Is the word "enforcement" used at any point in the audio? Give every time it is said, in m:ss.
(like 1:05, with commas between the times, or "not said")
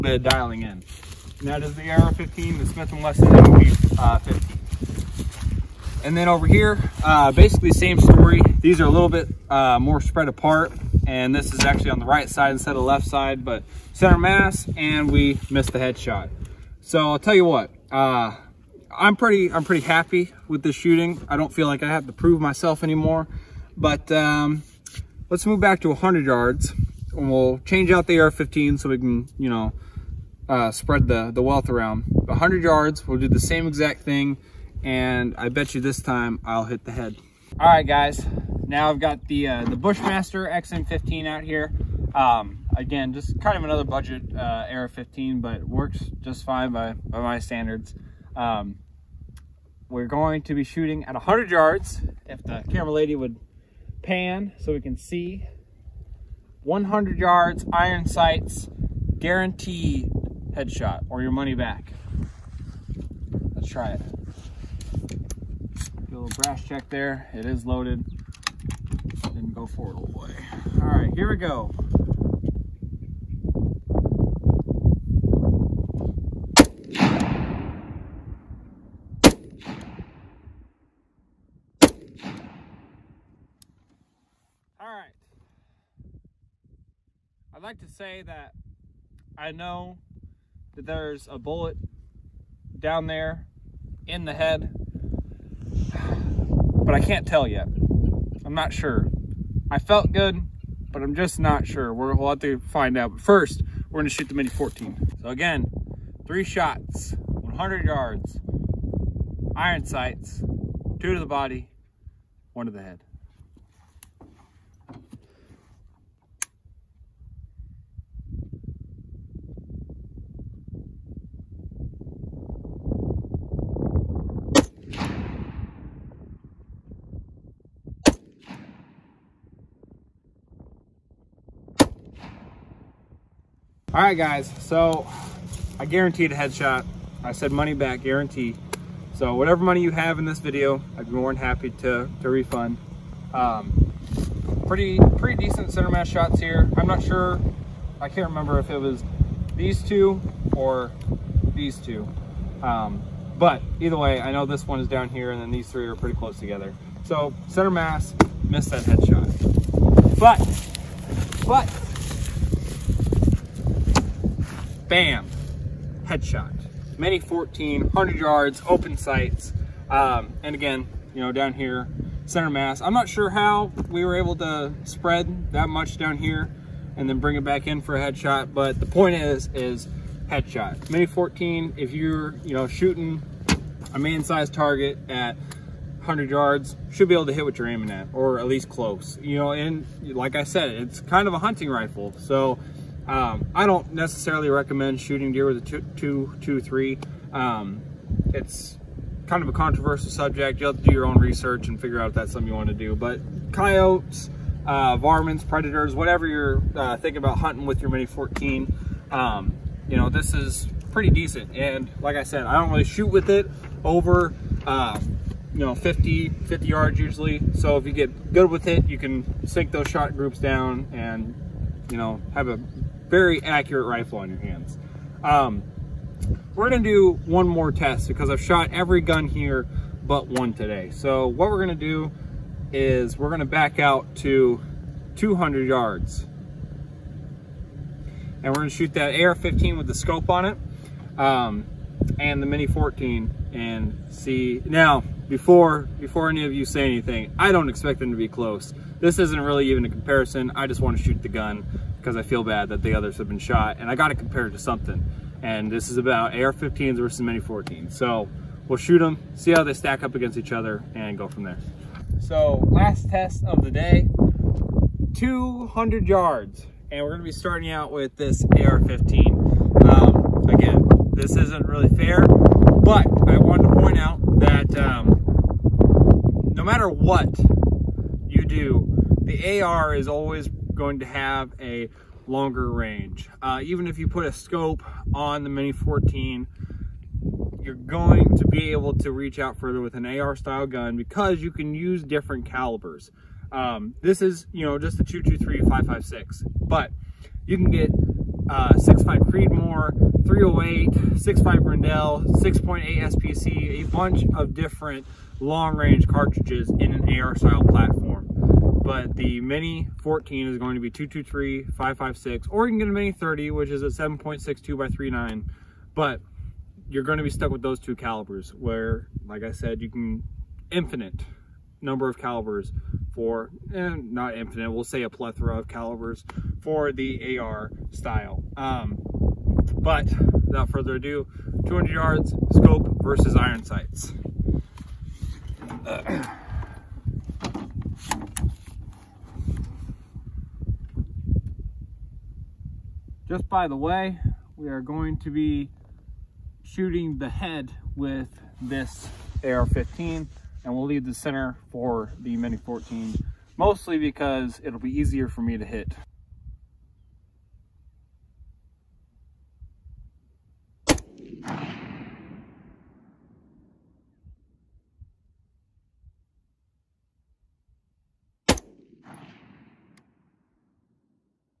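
not said.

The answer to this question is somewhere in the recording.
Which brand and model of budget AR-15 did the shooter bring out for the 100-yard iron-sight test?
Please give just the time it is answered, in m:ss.
0:39.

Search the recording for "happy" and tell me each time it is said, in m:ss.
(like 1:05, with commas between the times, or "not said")
0:19, 2:21.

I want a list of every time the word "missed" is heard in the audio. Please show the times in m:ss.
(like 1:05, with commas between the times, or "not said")
0:15, 2:38.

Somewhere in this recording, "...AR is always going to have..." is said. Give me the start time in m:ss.
4:39.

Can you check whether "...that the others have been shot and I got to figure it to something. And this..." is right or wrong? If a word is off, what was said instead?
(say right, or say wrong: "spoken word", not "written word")
wrong: "compare", not "figure".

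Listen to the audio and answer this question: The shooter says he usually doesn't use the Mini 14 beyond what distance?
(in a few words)
50 yards.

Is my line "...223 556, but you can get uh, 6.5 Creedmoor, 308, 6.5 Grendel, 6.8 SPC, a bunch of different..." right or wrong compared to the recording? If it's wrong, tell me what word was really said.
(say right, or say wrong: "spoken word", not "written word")
right.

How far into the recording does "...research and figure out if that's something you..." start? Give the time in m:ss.
3:21.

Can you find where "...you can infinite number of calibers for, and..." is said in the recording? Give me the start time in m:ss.
5:19.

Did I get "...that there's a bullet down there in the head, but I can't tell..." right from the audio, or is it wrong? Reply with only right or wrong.
right.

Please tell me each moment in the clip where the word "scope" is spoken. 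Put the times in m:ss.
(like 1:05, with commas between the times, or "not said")
3:59, 4:44, 5:32.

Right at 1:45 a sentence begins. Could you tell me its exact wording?
So again, three shots, 100 yards, iron sights, two to the body, one to the head.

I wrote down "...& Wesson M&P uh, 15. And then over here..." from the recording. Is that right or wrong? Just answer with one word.
right.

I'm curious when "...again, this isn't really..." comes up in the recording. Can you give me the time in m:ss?
4:30.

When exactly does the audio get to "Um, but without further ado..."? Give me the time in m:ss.
5:28.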